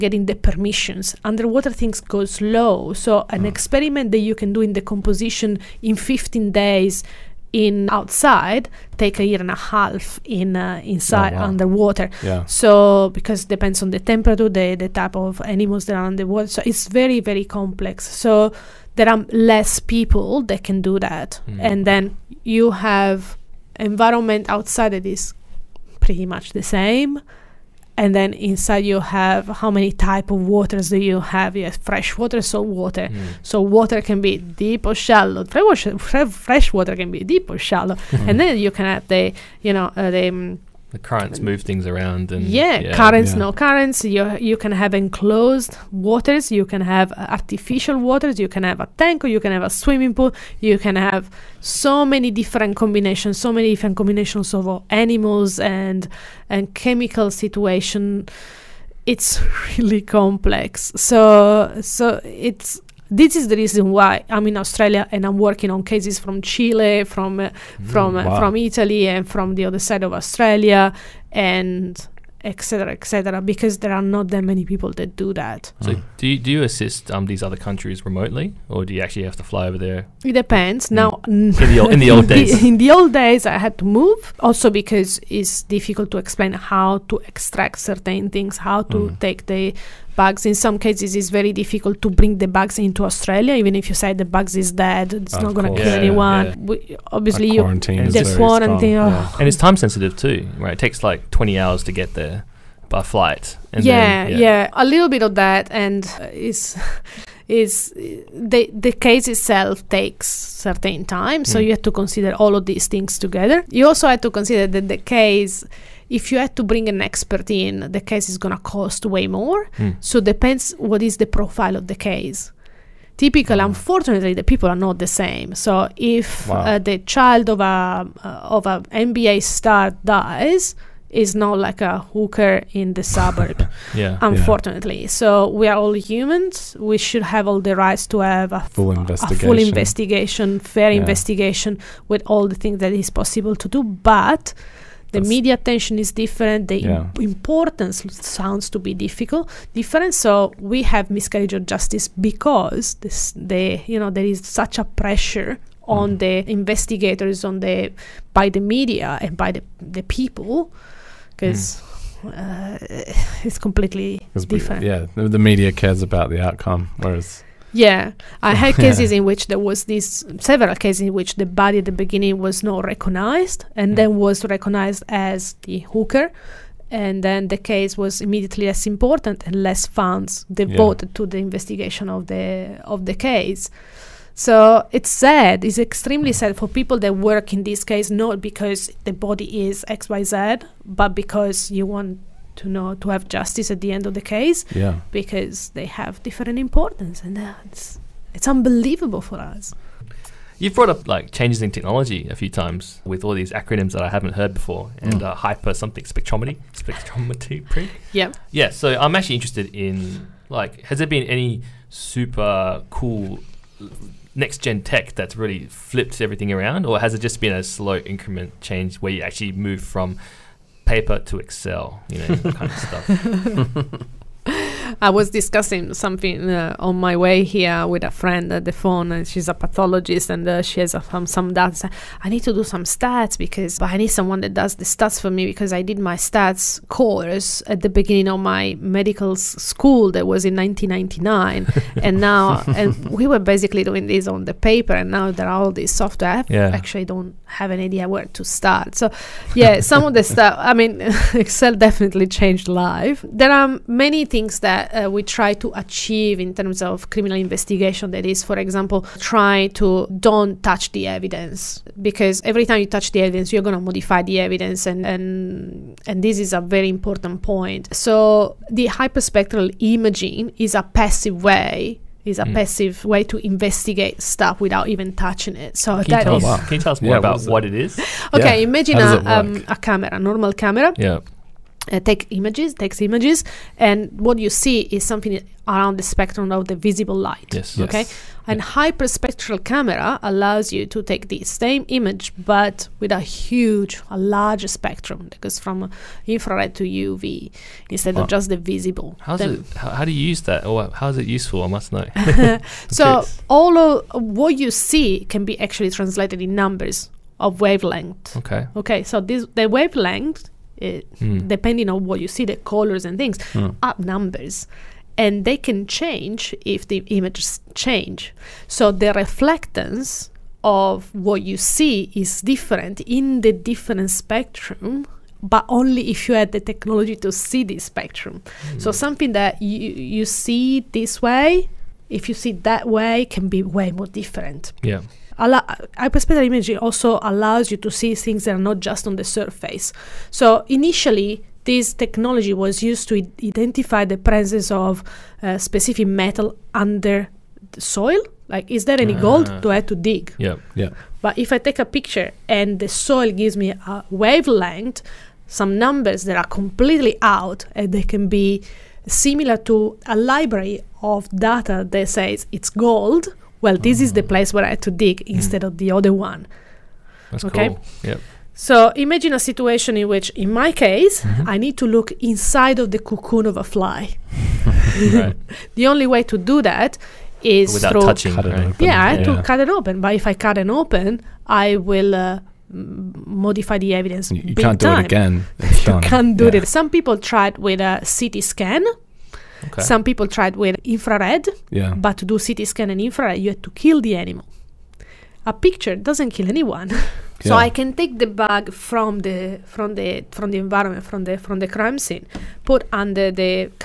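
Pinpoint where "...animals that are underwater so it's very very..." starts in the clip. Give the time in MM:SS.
00:15.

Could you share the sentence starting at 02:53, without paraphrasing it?
then was recognized as the hooker, and then the case was immediately less important and less funds devoted yeah.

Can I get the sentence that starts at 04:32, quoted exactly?
passive way to investigate stuff without even touching it.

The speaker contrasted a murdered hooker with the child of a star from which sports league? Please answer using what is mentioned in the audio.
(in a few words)
NBA.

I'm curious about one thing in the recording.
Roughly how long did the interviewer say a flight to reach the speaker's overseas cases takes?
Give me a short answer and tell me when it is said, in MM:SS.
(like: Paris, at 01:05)
20 hours, at 01:41.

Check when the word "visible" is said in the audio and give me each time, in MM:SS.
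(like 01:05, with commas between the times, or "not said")
04:46, 04:58.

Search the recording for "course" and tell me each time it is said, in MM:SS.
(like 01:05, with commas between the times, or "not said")
03:56.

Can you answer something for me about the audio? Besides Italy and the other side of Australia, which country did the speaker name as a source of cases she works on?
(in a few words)
Chile.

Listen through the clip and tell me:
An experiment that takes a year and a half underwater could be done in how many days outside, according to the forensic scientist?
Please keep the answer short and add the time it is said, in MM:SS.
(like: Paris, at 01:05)
15 days, at 00:05.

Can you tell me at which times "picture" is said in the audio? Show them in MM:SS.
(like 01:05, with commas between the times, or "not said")
05:51, 06:35.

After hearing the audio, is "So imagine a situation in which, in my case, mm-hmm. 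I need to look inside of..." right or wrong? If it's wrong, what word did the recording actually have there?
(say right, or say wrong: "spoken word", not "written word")
right.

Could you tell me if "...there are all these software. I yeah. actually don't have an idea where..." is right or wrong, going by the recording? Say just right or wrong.
right.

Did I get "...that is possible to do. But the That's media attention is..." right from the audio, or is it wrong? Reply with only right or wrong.
right.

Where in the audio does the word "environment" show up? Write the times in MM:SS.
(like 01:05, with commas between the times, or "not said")
00:23, 06:40.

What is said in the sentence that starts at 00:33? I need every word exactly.
so water can be deep or shallow fresh water, fresh water can be deep or shallow mm.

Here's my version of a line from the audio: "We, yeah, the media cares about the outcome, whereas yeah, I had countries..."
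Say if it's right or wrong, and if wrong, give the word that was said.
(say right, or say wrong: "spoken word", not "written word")
wrong: "cases", not "countries".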